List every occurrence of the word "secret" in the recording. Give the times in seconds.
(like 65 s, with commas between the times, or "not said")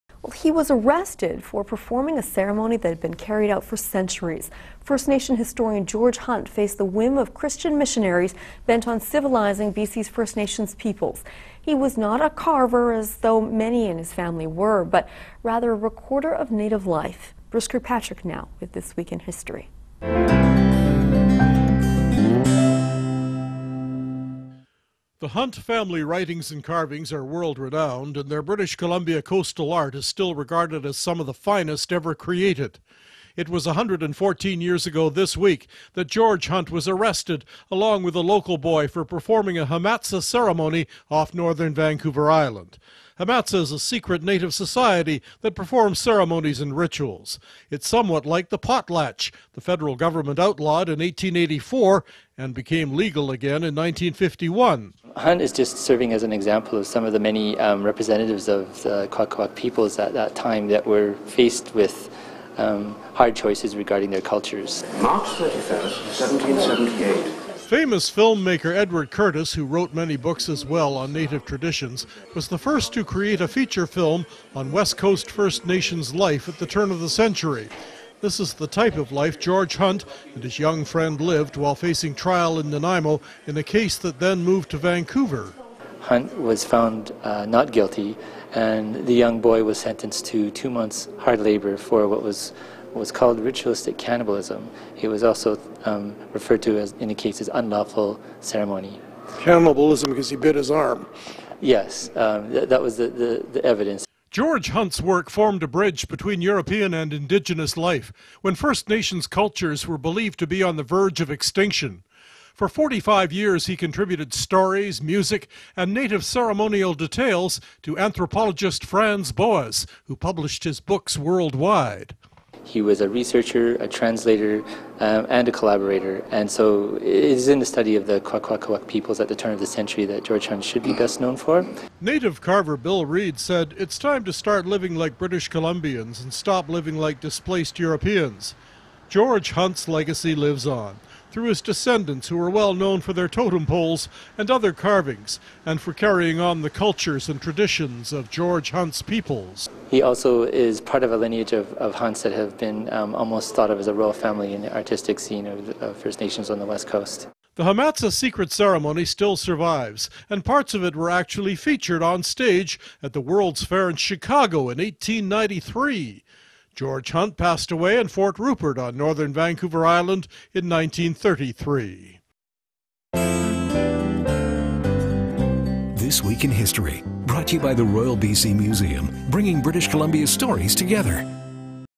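43 s, 158 s.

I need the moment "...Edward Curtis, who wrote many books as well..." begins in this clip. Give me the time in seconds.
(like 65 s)
68 s.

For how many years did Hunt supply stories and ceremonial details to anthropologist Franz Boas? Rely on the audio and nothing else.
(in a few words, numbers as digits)
45.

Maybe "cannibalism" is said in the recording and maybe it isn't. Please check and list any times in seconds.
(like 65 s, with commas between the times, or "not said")
93 s, 99 s.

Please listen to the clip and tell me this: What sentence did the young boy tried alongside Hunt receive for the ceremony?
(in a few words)
2 months hard labor.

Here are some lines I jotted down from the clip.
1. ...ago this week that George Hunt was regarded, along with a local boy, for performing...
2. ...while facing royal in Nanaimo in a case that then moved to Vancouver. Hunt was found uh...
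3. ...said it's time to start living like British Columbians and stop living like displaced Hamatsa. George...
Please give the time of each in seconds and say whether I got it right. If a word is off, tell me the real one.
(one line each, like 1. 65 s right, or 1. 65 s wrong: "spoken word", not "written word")
1. 34 s wrong: "arrested", not "regarded"
2. 81 s wrong: "trial", not "royal"
3. 133 s wrong: "Europeans", not "Hamatsa".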